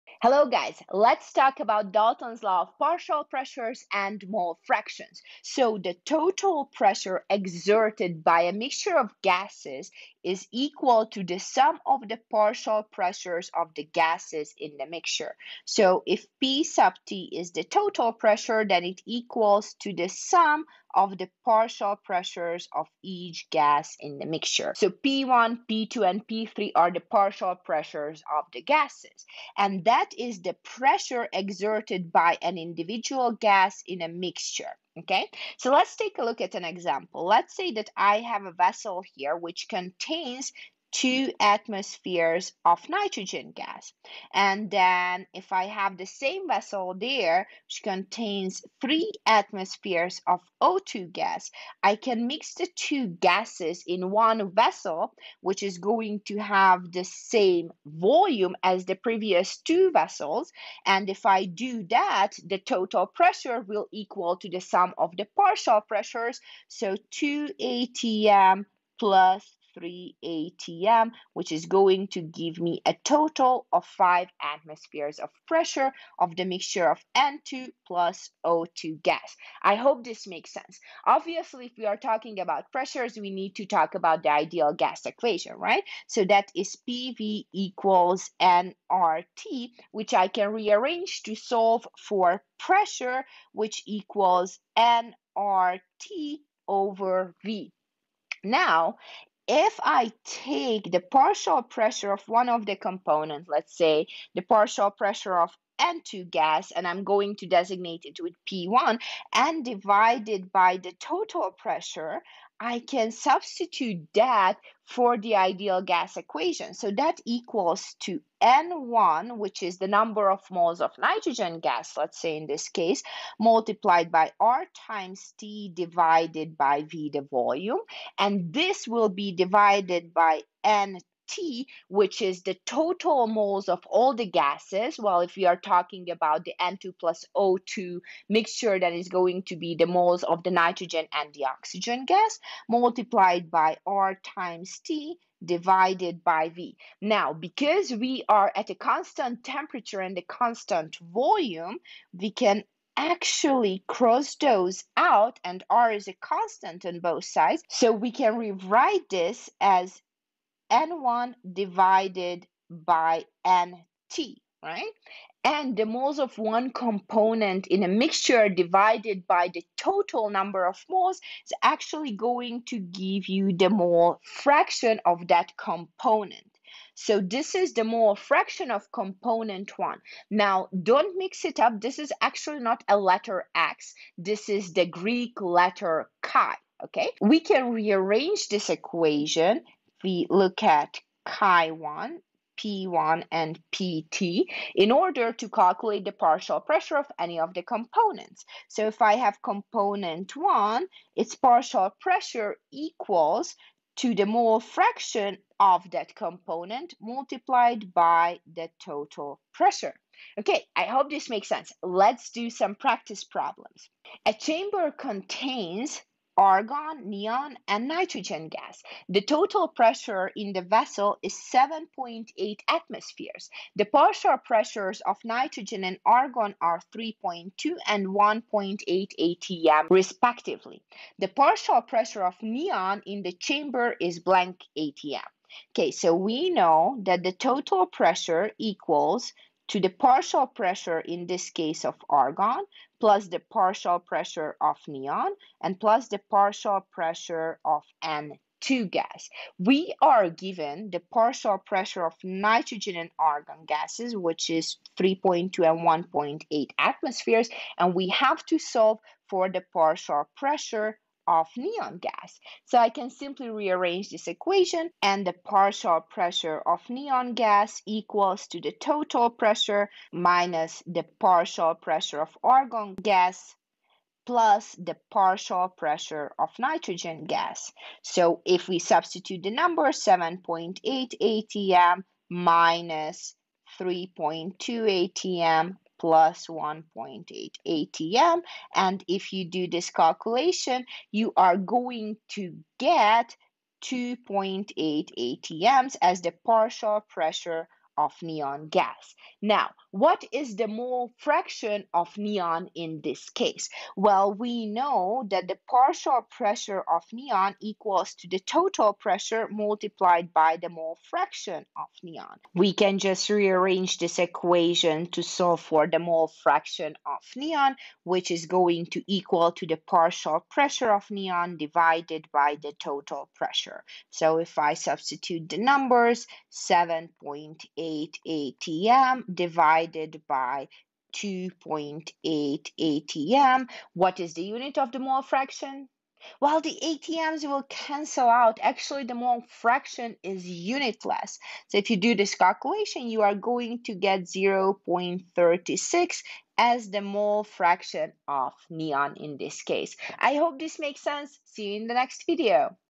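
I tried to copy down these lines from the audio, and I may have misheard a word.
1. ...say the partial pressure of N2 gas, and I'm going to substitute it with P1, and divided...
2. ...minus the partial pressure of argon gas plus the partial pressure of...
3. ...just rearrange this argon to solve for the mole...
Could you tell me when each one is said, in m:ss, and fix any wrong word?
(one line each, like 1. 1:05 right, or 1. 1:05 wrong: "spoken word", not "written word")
1. 1:43 wrong: "designate", not "substitute"
2. 4:30 right
3. 5:12 wrong: "equation", not "argon".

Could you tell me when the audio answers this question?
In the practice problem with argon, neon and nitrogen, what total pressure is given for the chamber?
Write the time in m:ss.
3:41.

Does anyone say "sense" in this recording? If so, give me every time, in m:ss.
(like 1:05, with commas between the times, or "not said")
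1:20, 3:31, 5:51.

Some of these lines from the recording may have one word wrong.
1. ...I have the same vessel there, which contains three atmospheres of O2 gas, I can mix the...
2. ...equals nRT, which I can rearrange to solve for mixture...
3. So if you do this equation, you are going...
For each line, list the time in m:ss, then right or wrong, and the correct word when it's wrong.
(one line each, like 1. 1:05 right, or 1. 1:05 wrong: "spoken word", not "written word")
1. 0:45 right
2. 1:27 wrong: "pressure", not "mixture"
3. 5:41 wrong: "calculation", not "equation".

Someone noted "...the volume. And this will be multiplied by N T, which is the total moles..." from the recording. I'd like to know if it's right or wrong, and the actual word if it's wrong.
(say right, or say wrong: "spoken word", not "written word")
wrong: "divided", not "multiplied".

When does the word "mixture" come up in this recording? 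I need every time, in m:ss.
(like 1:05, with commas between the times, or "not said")
0:08, 0:14, 0:24, 0:34, 1:16, 2:18, 2:47.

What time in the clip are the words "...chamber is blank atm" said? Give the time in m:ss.
3:53.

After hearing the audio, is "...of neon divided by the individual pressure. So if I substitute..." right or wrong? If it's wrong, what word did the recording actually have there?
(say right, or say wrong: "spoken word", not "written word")
wrong: "total", not "individual".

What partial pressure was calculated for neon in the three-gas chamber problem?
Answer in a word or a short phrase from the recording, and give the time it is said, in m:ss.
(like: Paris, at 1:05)
2.8 atm, at 4:53.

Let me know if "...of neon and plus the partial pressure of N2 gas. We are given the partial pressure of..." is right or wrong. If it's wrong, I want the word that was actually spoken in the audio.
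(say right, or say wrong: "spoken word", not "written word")
right.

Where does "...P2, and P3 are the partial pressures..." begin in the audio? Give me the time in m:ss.
0:25.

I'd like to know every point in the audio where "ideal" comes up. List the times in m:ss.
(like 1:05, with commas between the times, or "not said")
1:24, 1:55.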